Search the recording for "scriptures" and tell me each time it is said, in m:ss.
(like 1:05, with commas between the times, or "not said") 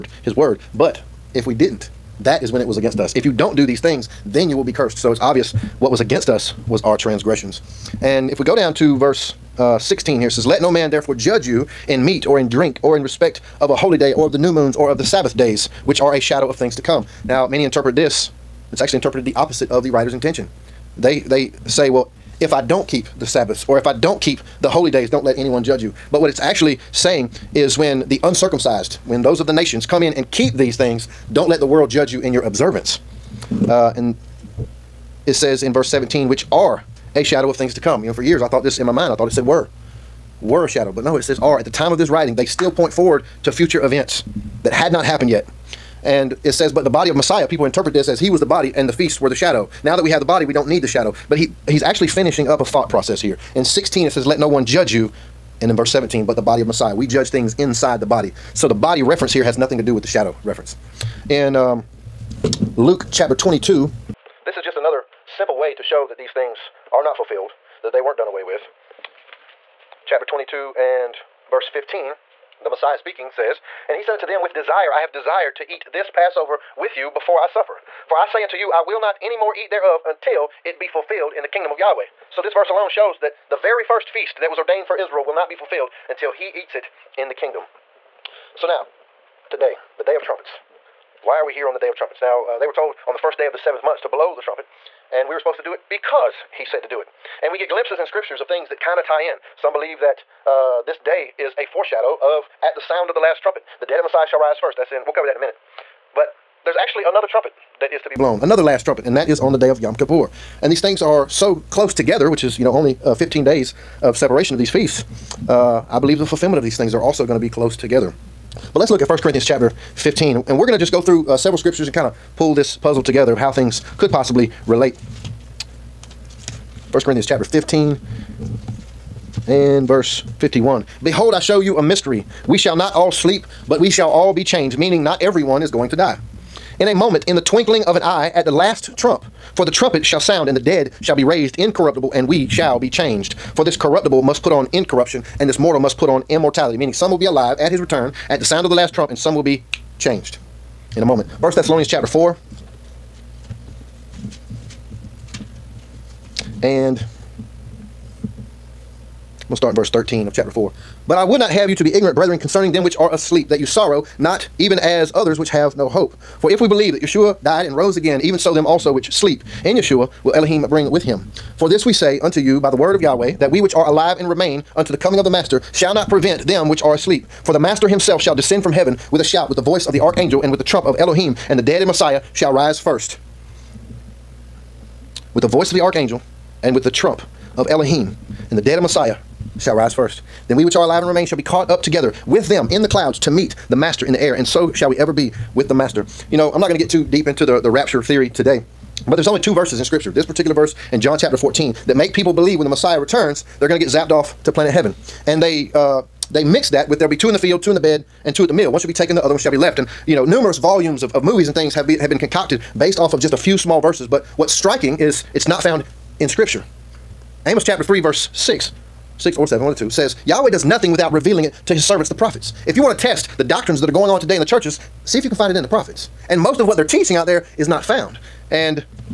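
1:38, 2:01, 3:19, 3:36.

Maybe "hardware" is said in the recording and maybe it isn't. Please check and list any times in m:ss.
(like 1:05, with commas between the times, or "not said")
not said.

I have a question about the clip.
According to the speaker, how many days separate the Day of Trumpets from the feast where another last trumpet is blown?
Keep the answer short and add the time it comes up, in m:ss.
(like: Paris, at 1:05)
15, at 1:53.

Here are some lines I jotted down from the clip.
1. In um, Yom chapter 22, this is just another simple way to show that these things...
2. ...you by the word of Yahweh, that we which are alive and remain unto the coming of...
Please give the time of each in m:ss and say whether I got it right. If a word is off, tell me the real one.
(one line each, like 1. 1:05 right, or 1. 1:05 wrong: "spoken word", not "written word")
1. 1:01 wrong: "Luke", not "Yom"
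2. 2:52 right.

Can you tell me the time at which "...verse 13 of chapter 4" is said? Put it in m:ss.
2:39.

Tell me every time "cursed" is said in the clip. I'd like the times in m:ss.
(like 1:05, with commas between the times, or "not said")
0:04.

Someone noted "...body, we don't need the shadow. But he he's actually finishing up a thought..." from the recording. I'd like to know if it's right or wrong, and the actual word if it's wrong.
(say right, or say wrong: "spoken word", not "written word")
right.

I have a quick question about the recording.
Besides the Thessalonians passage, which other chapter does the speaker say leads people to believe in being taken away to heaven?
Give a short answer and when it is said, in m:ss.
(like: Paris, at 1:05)
John chapter 14, at 3:21.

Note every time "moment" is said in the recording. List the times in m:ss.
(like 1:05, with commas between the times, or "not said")
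2:16, 2:31.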